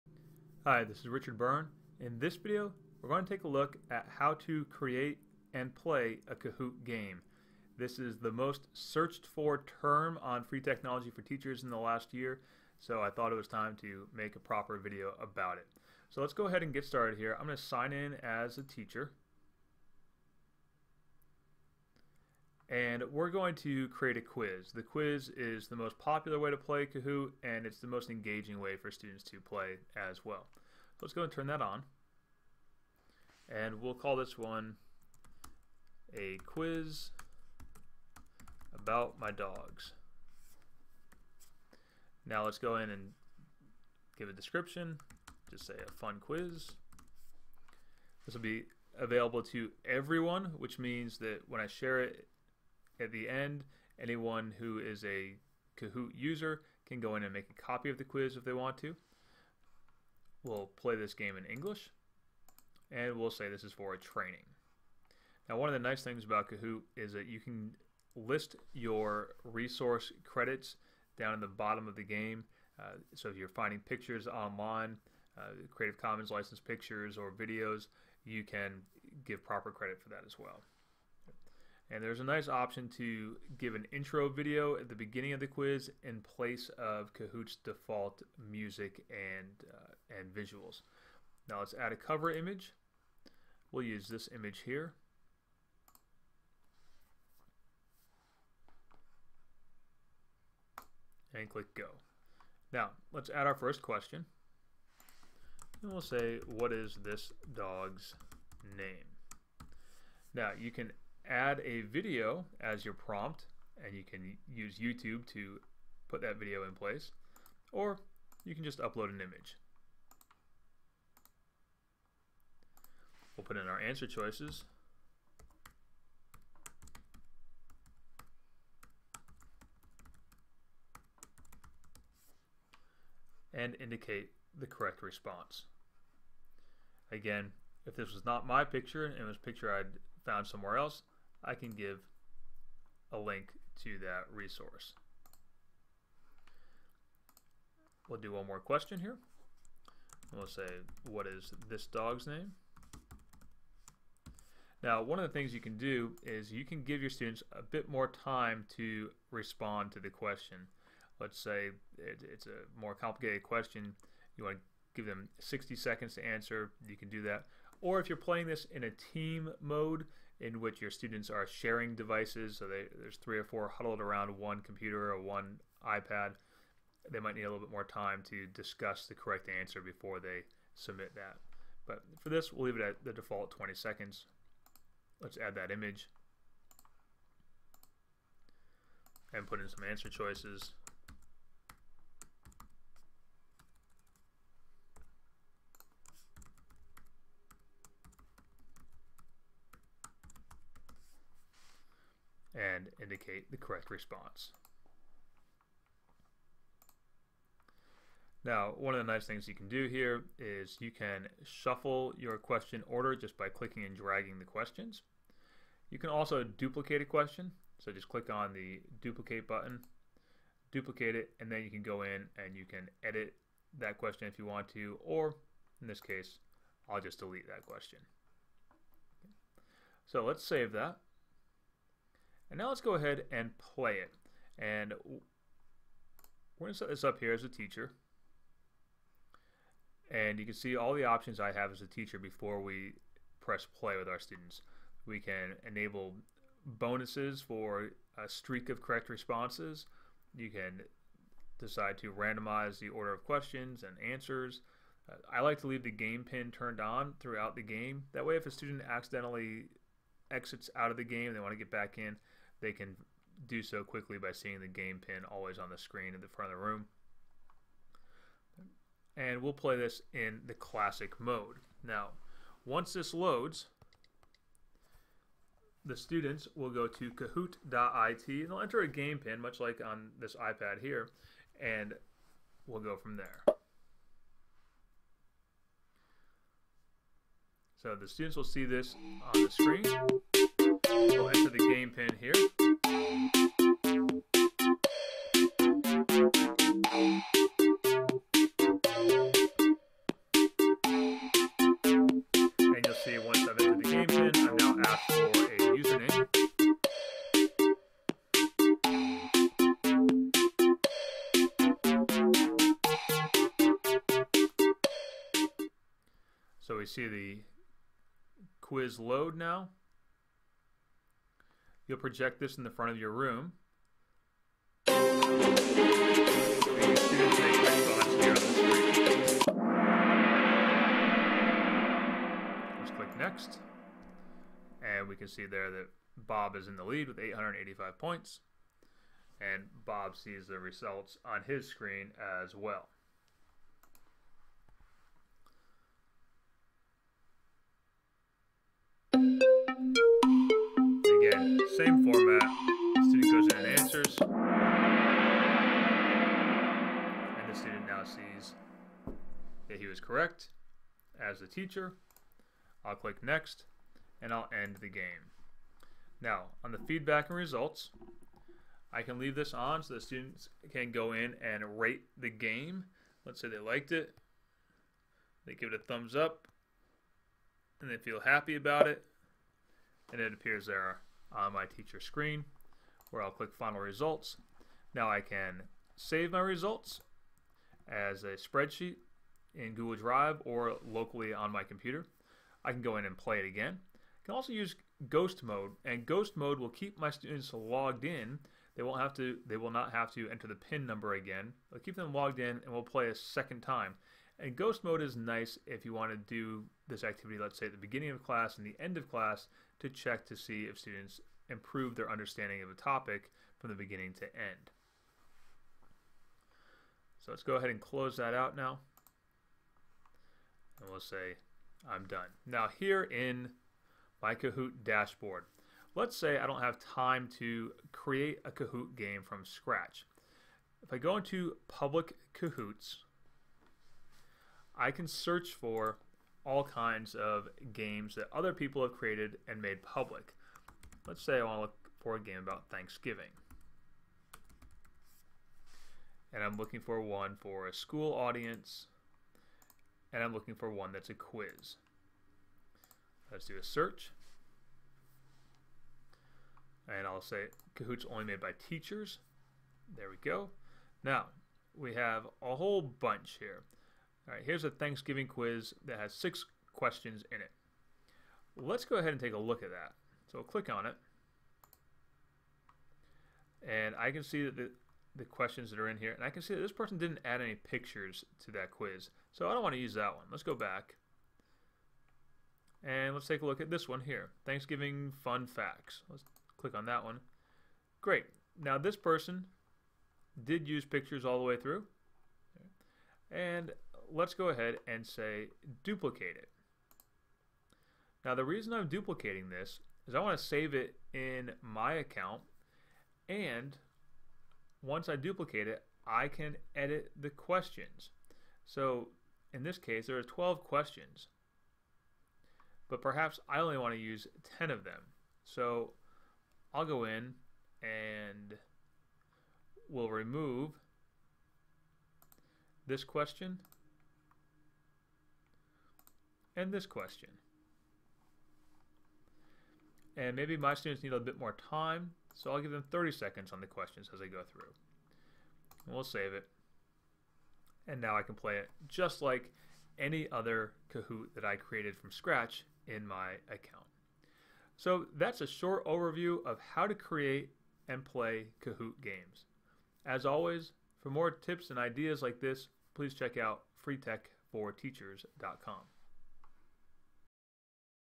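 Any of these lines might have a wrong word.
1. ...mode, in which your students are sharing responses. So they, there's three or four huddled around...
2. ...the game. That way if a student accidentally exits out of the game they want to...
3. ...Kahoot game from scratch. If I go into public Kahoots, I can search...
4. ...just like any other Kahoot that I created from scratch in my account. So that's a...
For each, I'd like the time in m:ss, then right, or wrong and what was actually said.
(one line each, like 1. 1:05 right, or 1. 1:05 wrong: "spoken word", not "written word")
1. 2:49 wrong: "devices", not "responses"
2. 4:17 right
3. 7:08 right
4. 8:58 right.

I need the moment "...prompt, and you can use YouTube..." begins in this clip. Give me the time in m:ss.
1:52.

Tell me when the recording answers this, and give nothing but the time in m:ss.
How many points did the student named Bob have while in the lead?
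5:37.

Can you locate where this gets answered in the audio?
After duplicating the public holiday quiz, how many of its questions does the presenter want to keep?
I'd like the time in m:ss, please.
8:34.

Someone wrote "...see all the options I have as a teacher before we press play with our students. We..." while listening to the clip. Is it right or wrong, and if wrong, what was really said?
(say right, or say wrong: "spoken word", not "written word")
right.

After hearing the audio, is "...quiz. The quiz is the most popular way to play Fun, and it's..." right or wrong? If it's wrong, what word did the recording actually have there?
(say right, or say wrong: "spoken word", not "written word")
wrong: "Kahoot", not "Fun".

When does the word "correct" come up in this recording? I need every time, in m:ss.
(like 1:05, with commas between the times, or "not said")
2:14, 2:59, 3:23, 4:08, 6:00.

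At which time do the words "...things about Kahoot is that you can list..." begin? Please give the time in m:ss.
1:06.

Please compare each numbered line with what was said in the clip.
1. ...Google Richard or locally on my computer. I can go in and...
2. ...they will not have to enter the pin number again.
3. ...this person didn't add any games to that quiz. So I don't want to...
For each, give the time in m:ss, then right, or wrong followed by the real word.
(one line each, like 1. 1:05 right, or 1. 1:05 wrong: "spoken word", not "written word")
1. 6:29 wrong: "Drive", not "Richard"
2. 6:39 right
3. 7:56 wrong: "pictures", not "games".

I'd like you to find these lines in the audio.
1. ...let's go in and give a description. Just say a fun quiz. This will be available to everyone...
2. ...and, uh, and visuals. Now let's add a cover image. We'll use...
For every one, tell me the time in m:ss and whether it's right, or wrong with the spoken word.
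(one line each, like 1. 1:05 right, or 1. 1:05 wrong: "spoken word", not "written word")
1. 0:42 right
2. 1:29 right.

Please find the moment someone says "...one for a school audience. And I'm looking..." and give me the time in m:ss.
7:26.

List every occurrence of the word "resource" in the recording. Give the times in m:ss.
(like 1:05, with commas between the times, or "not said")
1:09, 2:24.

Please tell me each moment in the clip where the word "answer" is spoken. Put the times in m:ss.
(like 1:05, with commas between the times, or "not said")
2:03, 2:46, 2:59, 3:09, 4:14, 5:53.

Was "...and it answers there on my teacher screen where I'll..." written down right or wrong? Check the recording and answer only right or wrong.
wrong.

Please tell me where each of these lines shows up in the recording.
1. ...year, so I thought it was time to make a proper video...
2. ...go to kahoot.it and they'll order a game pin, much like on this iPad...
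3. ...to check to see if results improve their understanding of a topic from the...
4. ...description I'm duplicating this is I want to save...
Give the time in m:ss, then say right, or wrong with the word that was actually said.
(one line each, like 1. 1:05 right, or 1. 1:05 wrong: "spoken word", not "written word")
1. 0:12 right
2. 4:36 wrong: "enter", not "order"
3. 6:49 wrong: "students", not "results"
4. 8:18 wrong: "reason", not "description".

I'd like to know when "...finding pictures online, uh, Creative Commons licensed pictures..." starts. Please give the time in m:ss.
1:13.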